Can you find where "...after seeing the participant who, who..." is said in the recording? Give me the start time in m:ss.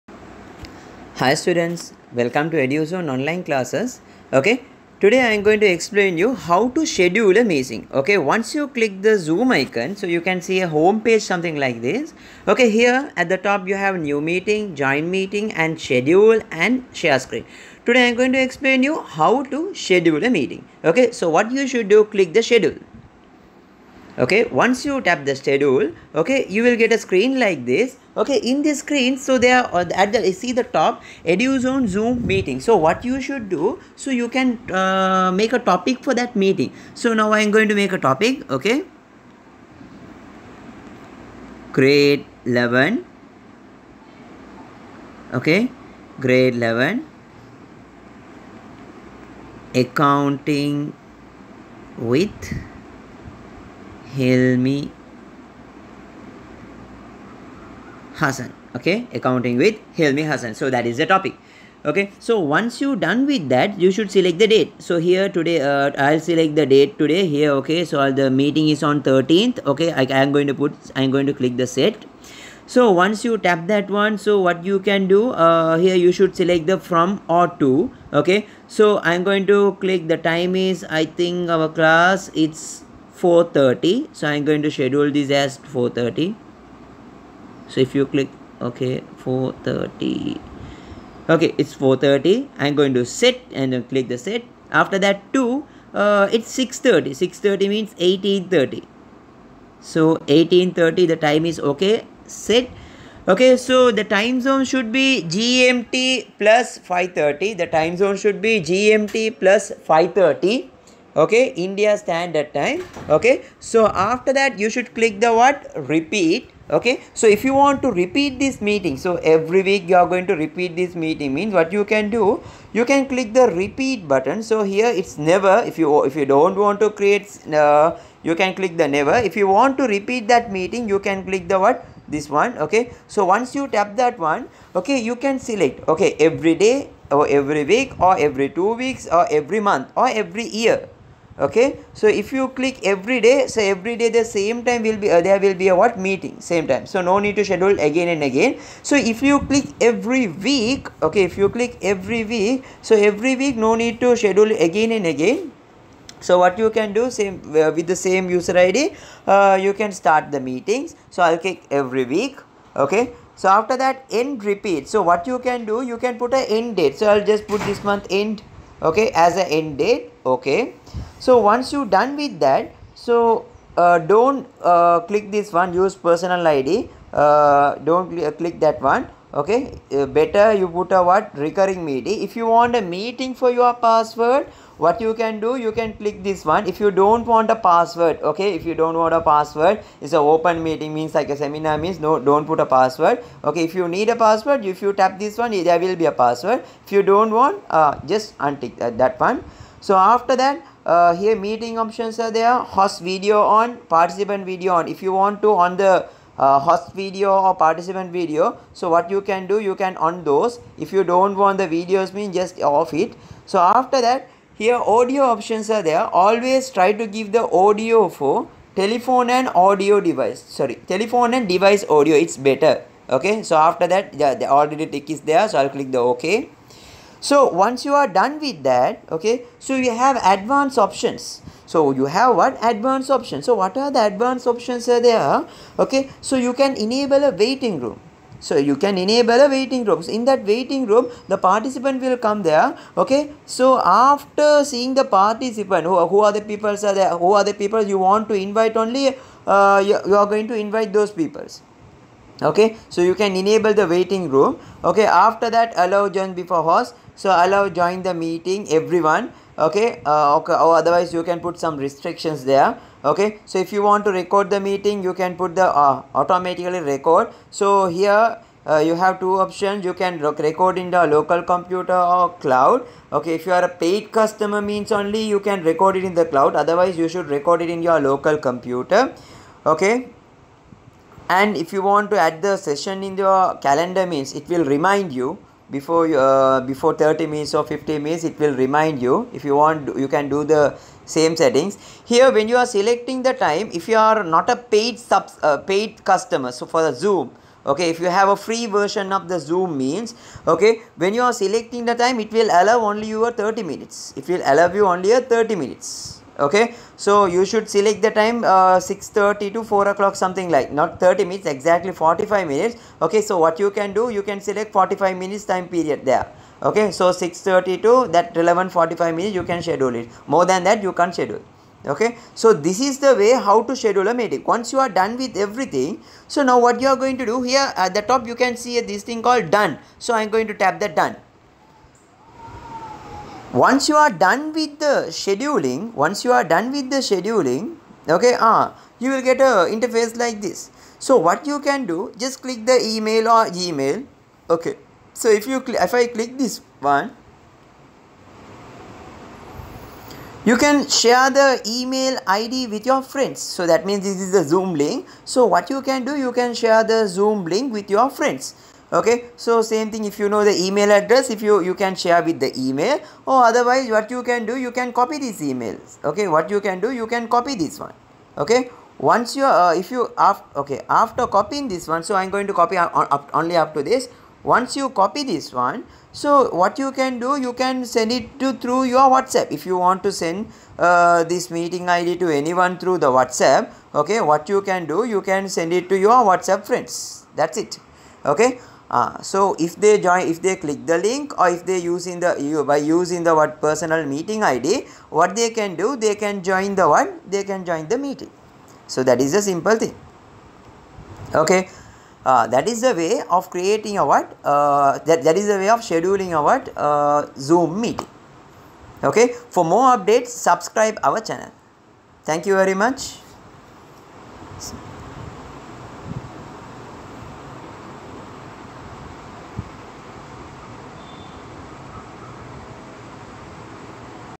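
4:03.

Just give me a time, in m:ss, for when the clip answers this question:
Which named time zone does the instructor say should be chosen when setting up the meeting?
1:51.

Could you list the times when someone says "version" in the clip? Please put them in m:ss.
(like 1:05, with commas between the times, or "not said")
4:58.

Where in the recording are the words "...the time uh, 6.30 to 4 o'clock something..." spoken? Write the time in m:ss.
5:08.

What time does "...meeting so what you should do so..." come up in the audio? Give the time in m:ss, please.
0:32.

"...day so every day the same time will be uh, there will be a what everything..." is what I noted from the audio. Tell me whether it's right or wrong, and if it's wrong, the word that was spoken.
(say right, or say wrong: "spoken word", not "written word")
wrong: "meeting", not "everything".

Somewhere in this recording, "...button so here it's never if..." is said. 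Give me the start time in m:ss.
2:04.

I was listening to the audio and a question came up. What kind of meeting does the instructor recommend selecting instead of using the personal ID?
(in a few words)
Recurring meeting.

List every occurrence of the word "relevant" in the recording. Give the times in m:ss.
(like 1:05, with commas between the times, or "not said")
5:18.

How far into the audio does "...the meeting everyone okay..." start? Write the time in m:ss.
4:18.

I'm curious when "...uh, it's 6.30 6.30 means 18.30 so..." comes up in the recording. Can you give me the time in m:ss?
1:35.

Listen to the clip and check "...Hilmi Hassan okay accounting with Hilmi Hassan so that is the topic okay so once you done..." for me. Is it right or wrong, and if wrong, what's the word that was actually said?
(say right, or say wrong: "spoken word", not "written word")
right.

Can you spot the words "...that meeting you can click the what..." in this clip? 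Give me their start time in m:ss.
2:10.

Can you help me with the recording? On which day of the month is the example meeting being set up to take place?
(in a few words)
13th.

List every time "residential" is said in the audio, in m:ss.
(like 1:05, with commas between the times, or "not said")
not said.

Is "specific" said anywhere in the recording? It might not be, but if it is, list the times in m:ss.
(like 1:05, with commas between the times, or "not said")
not said.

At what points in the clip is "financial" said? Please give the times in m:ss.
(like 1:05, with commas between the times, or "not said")
not said.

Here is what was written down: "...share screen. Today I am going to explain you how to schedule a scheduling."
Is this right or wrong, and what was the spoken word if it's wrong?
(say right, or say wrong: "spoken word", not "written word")
wrong: "meeting", not "scheduling".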